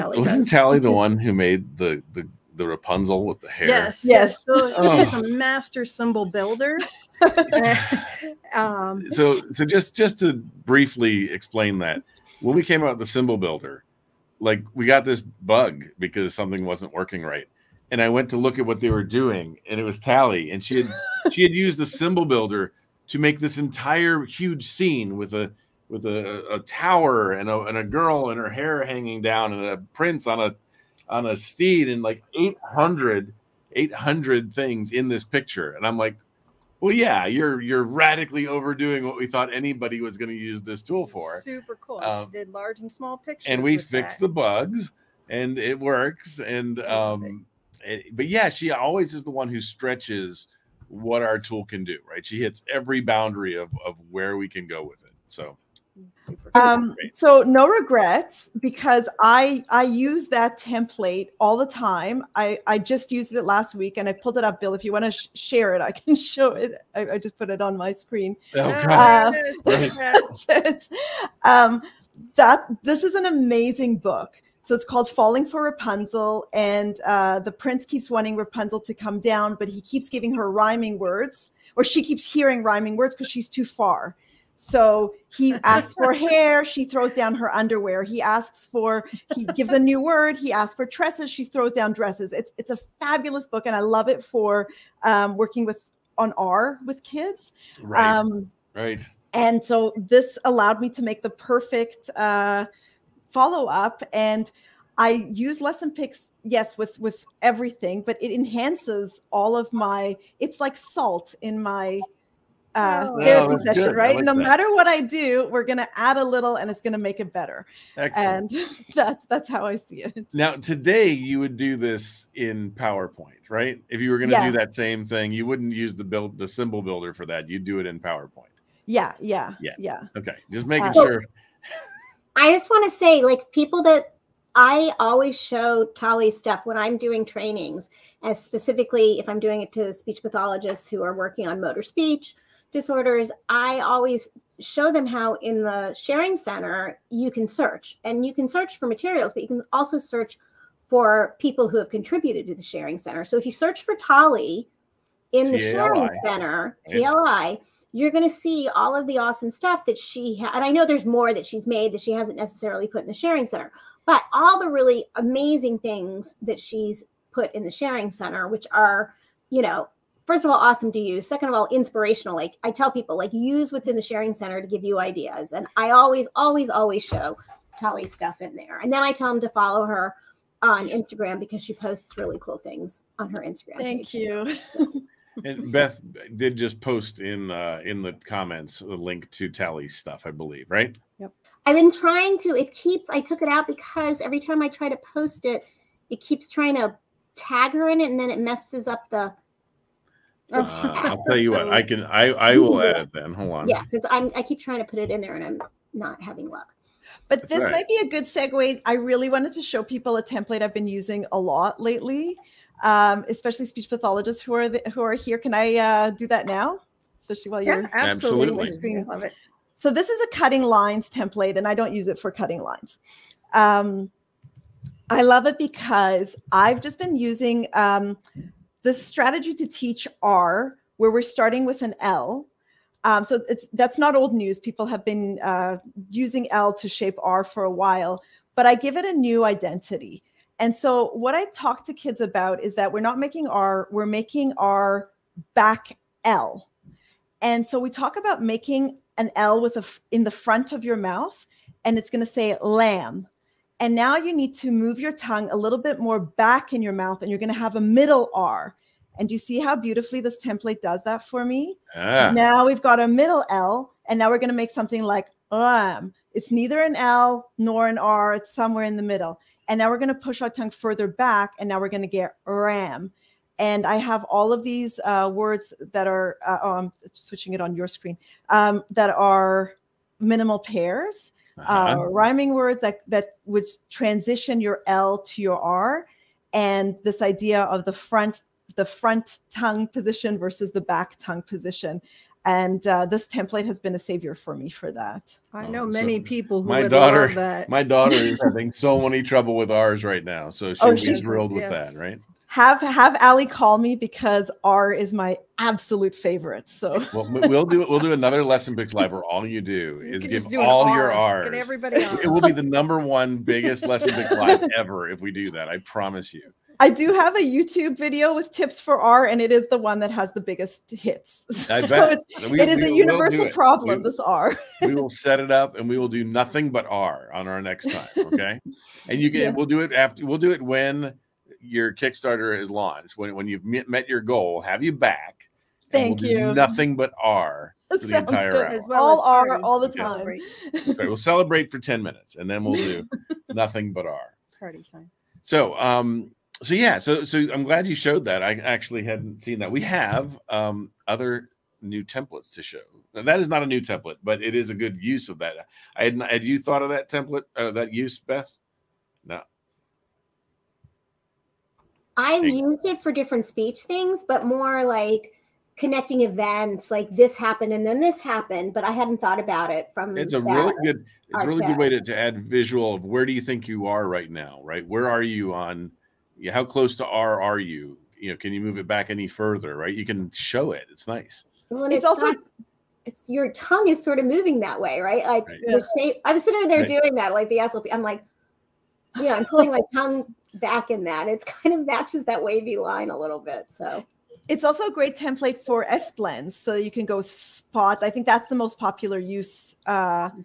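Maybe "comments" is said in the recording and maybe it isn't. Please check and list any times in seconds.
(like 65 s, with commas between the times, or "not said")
188 s.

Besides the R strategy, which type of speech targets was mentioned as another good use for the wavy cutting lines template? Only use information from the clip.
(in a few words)
S blends.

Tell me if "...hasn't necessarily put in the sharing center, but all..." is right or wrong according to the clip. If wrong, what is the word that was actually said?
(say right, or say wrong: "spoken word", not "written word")
right.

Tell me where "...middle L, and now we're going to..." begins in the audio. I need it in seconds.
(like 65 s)
263 s.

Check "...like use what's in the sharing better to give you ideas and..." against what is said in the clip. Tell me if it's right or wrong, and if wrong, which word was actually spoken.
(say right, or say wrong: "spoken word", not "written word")
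wrong: "center", not "better".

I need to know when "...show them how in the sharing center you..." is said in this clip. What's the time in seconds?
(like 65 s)
144 s.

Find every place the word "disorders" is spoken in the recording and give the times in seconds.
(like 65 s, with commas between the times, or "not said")
142 s.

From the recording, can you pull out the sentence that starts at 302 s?
have have Ali call me because R is my absolute favorite.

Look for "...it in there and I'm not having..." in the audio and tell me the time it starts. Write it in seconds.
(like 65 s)
204 s.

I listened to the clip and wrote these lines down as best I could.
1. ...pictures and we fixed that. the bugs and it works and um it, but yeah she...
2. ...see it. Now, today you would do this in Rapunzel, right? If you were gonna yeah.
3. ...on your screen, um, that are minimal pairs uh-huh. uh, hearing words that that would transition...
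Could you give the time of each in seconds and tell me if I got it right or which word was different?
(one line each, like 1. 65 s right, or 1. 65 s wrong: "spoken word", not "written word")
1. 43 s right
2. 119 s wrong: "PowerPoint", not "Rapunzel"
3. 277 s wrong: "rhyming", not "hearing".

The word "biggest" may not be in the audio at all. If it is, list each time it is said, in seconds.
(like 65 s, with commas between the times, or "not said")
313 s, 320 s.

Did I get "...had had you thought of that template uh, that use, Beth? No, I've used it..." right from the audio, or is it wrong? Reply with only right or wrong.
right.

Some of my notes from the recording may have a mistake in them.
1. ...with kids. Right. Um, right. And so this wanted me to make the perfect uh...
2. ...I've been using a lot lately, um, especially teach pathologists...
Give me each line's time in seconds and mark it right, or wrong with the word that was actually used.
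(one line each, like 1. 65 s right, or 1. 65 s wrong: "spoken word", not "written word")
1. 96 s wrong: "allowed", not "wanted"
2. 210 s wrong: "speech", not "teach".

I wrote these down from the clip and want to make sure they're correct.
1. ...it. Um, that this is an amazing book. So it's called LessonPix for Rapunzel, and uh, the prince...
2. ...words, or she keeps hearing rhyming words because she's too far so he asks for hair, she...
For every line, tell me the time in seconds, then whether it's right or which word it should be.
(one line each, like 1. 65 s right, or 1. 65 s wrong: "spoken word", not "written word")
1. 70 s wrong: "Falling", not "LessonPix"
2. 80 s right.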